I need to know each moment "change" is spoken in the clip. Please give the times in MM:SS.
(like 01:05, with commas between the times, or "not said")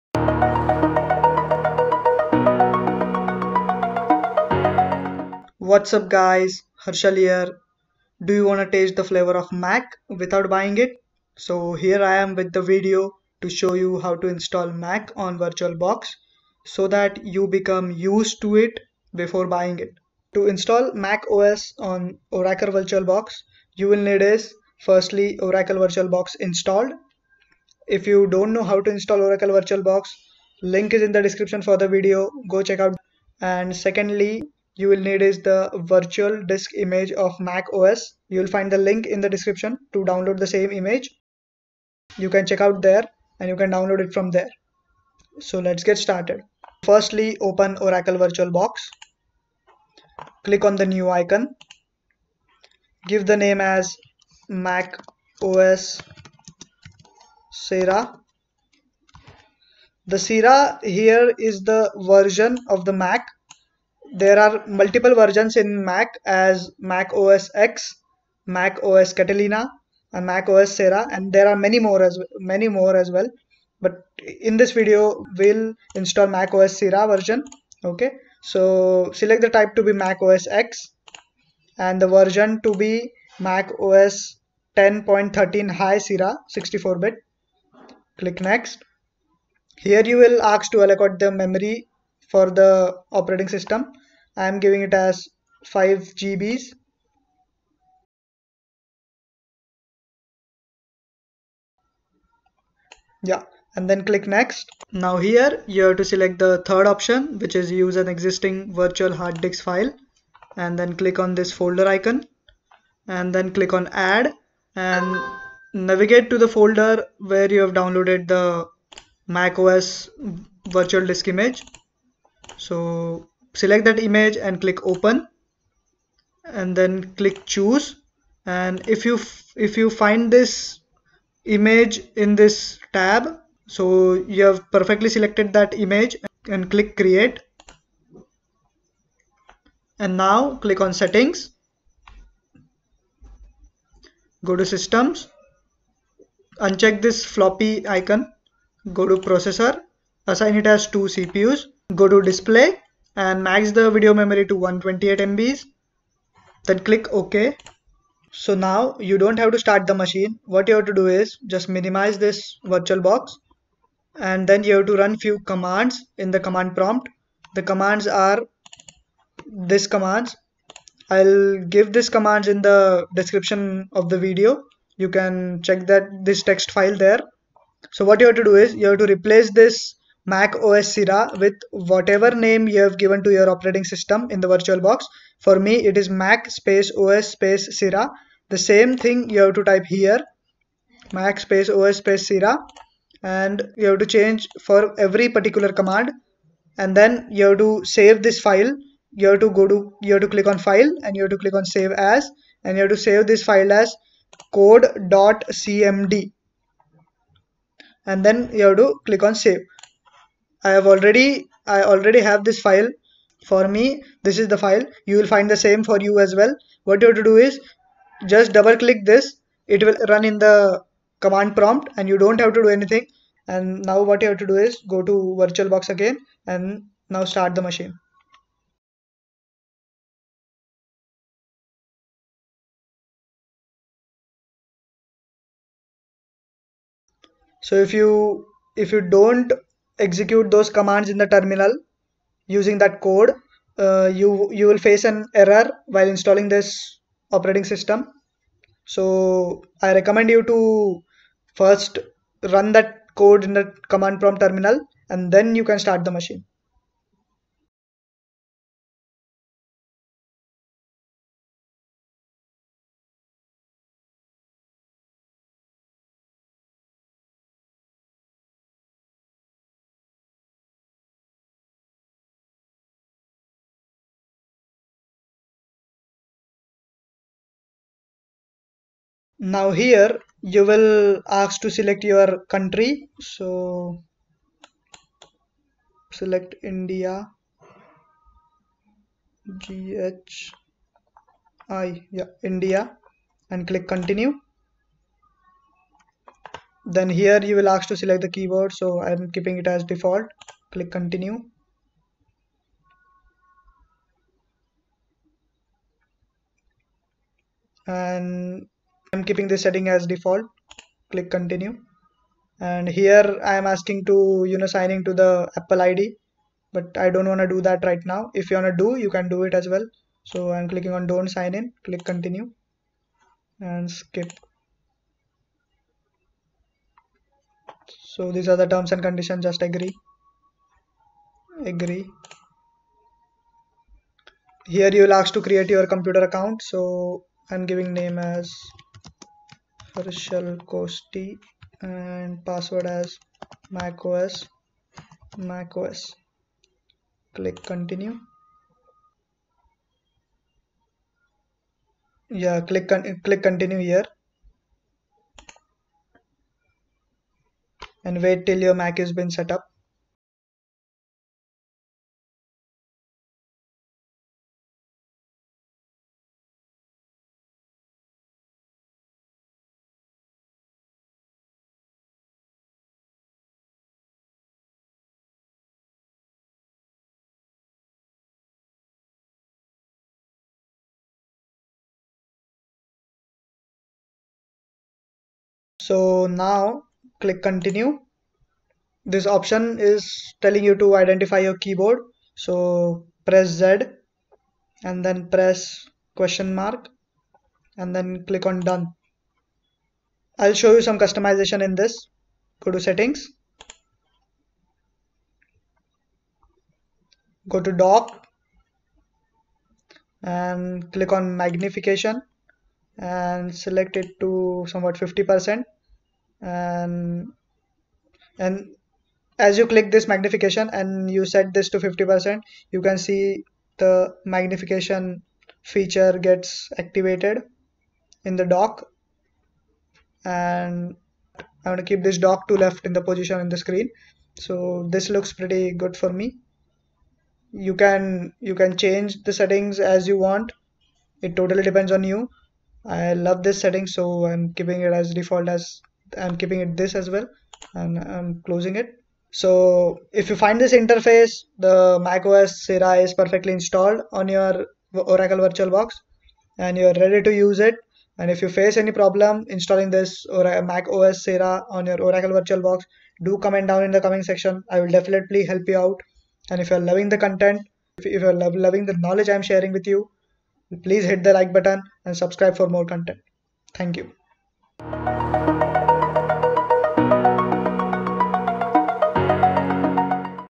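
03:14, 07:18.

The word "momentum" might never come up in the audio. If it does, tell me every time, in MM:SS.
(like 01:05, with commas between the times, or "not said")
not said.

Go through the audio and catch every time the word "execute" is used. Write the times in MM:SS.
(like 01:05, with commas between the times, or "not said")
04:00.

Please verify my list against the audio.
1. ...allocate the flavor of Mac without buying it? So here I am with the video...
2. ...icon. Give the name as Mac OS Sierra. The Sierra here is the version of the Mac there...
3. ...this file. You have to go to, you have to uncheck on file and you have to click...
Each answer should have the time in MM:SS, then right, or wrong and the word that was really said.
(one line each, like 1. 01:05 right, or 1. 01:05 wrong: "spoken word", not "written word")
1. 00:08 wrong: "taste", not "allocate"
2. 00:51 right
3. 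03:18 wrong: "click", not "uncheck".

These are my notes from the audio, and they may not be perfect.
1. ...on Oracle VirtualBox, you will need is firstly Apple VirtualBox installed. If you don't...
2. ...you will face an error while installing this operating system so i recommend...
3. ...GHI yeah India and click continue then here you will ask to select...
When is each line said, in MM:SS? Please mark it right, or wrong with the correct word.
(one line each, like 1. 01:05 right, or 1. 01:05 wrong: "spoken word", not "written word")
1. 00:21 wrong: "Oracle", not "Apple"
2. 04:04 right
3. 04:49 right.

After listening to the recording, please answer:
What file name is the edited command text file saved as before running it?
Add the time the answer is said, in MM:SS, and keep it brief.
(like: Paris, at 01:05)
code.cmd, at 03:24.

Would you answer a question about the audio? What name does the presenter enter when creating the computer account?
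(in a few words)
Harshal Koshti.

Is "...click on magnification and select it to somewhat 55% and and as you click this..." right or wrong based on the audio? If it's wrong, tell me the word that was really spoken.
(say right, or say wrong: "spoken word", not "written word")
wrong: "50", not "55".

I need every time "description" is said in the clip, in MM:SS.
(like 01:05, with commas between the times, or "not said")
00:31, 00:39, 02:53.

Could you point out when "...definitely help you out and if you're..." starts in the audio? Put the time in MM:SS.
07:44.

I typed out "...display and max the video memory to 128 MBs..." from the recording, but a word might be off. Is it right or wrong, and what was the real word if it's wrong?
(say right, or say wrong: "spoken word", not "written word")
right.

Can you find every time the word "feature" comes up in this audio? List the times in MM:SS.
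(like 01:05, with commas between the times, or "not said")
07:05.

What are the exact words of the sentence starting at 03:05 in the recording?
For me, it is Mac space OS space Sierra.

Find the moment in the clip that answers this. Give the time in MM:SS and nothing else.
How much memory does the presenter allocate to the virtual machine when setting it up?
01:35.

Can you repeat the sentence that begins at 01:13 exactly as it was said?
But in this video, we'll install Mac OS Sierra version.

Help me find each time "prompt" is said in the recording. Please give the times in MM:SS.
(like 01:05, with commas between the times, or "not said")
02:46, 03:41, 04:14.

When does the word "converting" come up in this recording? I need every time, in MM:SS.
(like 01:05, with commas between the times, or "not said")
not said.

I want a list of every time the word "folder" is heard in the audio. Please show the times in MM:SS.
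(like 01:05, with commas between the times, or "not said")
01:51, 01:56.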